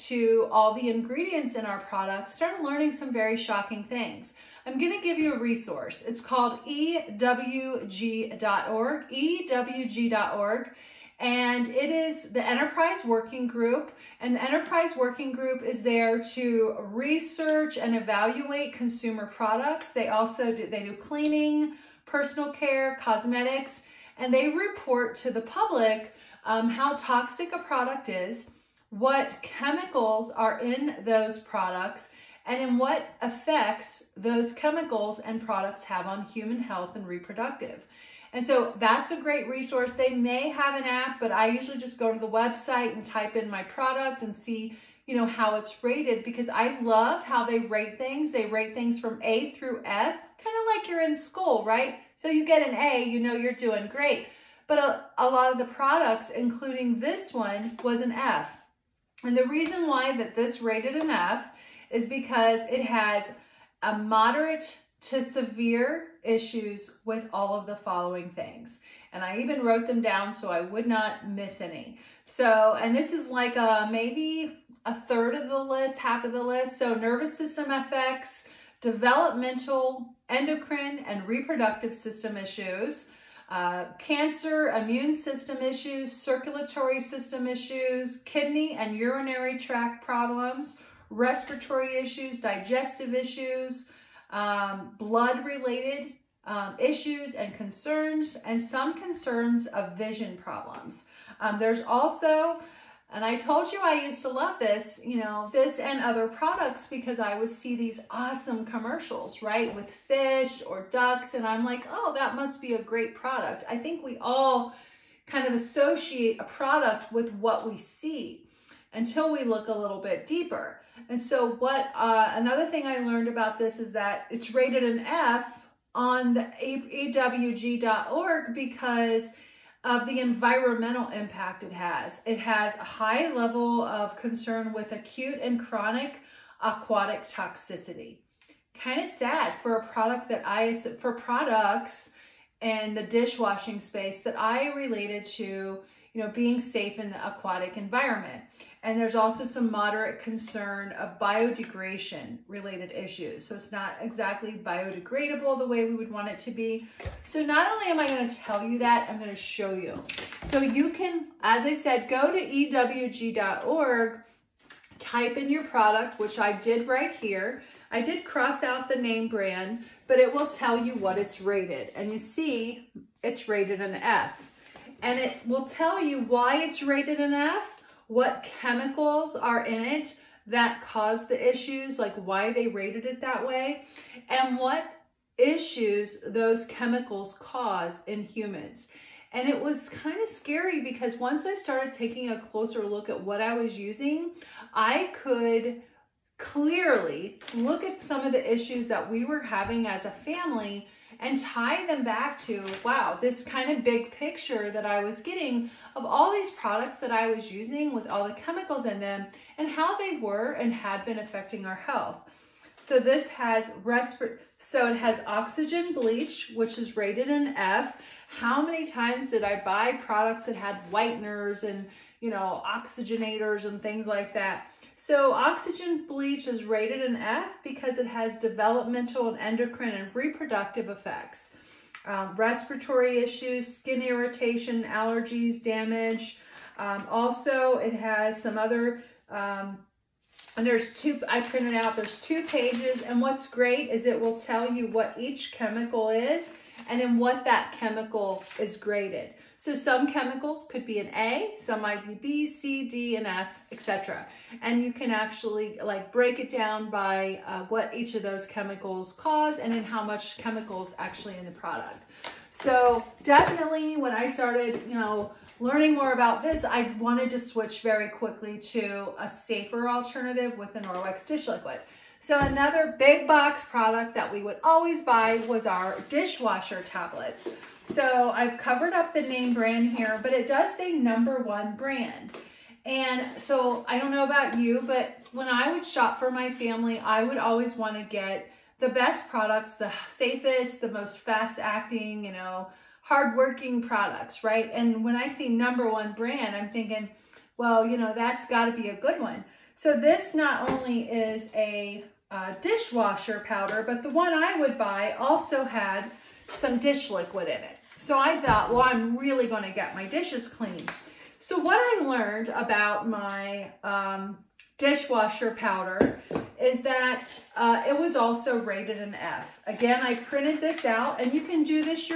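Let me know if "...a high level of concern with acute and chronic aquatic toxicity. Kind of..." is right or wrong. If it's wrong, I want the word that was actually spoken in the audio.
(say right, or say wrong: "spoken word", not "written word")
right.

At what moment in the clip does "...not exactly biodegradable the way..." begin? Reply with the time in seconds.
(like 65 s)
153 s.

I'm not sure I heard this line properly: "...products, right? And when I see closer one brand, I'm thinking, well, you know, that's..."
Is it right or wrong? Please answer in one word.
wrong.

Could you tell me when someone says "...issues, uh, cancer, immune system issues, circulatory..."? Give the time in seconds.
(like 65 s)
82 s.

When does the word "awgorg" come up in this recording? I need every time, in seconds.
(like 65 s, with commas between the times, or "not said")
126 s.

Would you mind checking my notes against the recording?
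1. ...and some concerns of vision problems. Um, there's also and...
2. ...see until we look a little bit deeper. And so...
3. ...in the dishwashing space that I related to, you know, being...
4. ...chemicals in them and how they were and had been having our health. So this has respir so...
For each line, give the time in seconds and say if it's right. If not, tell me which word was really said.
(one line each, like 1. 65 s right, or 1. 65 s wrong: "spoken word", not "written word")
1. 98 s right
2. 117 s right
3. 142 s right
4. 208 s wrong: "affecting", not "having".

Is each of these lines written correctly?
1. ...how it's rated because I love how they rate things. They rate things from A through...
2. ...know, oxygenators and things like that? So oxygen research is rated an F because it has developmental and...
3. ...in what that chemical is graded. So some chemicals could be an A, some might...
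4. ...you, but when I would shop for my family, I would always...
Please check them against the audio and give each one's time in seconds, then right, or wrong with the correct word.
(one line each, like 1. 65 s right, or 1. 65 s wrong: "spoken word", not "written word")
1. 45 s right
2. 222 s wrong: "bleach", not "research"
3. 246 s right
4. 284 s right.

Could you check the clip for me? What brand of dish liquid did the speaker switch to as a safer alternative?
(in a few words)
Norwex.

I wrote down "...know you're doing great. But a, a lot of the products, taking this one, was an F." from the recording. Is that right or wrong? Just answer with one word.
wrong.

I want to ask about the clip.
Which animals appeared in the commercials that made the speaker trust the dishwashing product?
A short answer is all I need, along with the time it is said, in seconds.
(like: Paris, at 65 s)
fish or ducks, at 109 s.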